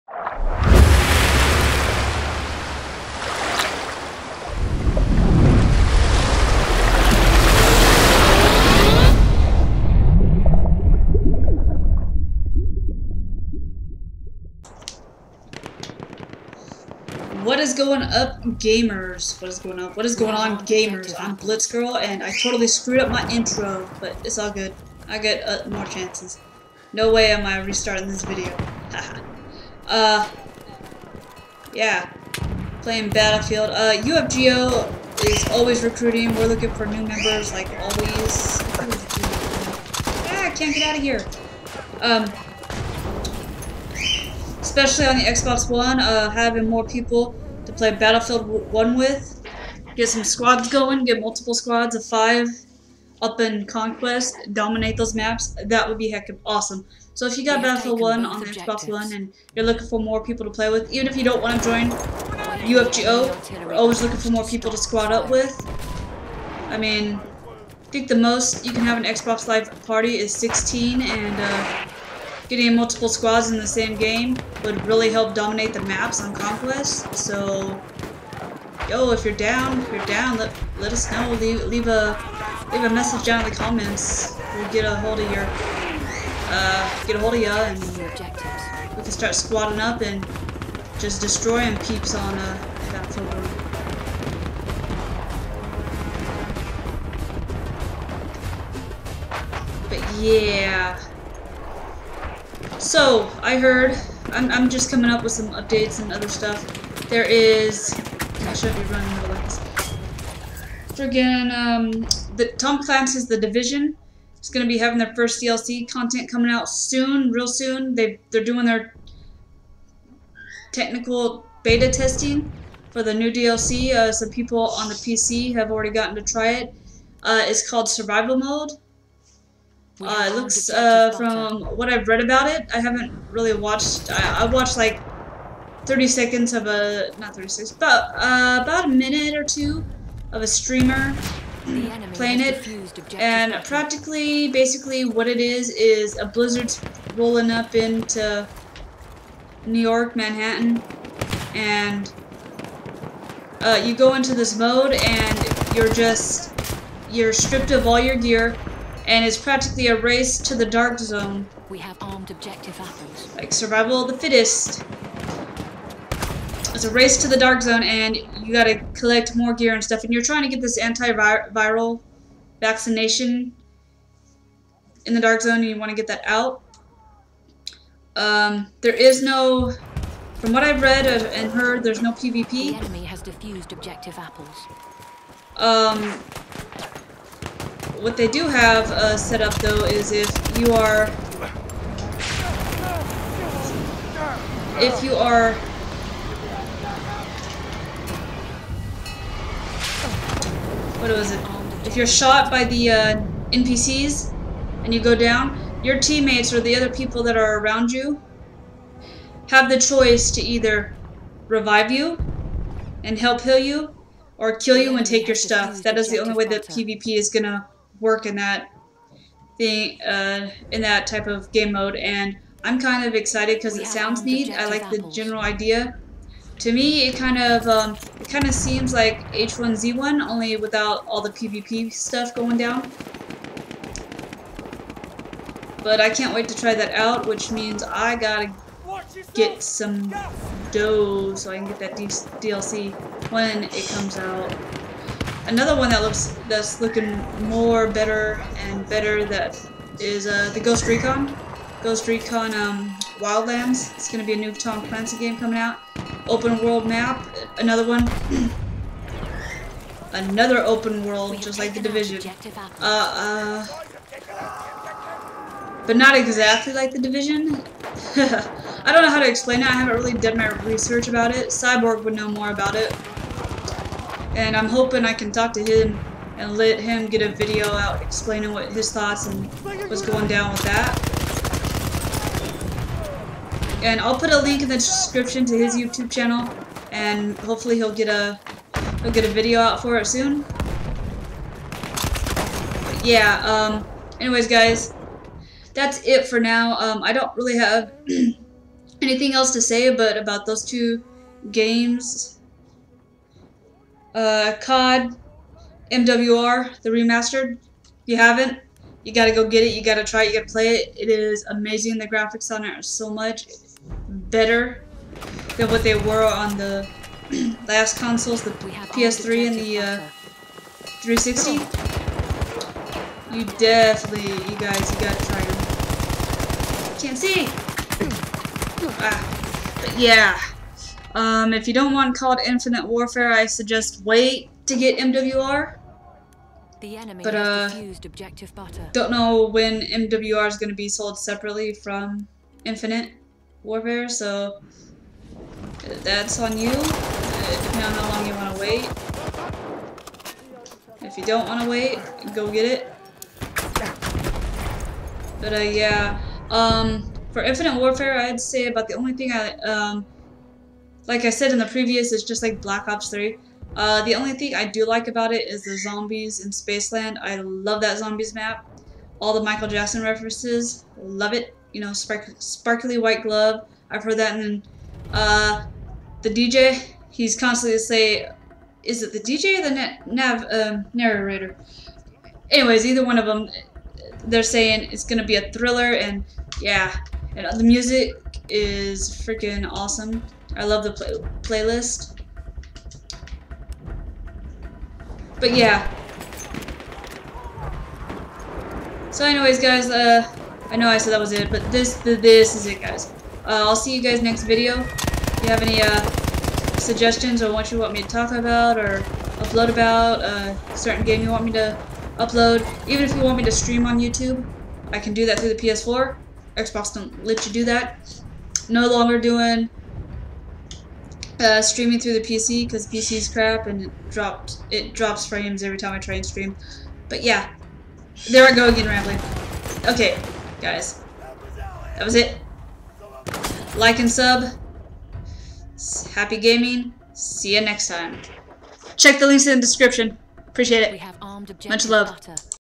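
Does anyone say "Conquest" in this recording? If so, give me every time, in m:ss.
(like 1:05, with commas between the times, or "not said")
0:53, 1:16.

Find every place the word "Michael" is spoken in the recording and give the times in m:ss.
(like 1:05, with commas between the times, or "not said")
6:09.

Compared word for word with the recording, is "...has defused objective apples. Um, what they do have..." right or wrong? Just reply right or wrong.
right.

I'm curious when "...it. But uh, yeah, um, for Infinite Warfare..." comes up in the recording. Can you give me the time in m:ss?
5:52.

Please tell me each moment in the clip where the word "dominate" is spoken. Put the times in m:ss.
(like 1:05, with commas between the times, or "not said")
0:54, 1:15.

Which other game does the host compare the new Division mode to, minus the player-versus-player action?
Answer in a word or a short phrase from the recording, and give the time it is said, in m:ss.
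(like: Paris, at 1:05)
H1Z1, at 3:49.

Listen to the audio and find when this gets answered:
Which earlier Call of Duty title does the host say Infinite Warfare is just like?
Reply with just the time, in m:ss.
6:02.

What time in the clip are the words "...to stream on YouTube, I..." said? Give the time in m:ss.
6:53.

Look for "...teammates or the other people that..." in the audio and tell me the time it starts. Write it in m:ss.
3:25.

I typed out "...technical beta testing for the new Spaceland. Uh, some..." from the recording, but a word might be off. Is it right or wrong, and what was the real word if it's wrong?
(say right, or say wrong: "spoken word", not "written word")
wrong: "DLC", not "Spaceland".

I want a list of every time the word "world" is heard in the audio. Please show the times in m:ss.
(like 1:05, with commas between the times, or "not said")
4:16, 4:21.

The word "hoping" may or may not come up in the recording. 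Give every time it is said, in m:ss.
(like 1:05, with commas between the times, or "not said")
4:34.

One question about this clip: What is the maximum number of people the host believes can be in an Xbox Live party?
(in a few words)
16.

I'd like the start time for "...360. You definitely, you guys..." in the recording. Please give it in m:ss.
5:21.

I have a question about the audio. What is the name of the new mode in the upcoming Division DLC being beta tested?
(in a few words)
Survival Mode.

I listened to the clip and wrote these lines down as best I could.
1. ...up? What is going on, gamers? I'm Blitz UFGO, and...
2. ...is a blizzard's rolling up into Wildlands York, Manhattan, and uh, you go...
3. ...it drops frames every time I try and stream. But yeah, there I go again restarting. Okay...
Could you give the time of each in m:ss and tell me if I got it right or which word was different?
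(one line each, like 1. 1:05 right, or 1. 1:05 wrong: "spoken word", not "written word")
1. 0:19 wrong: "Girl", not "UFGO"
2. 2:25 wrong: "New", not "Wildlands"
3. 7:04 wrong: "rambling", not "restarting".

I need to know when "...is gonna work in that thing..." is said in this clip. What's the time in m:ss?
3:37.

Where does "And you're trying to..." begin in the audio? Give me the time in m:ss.
2:50.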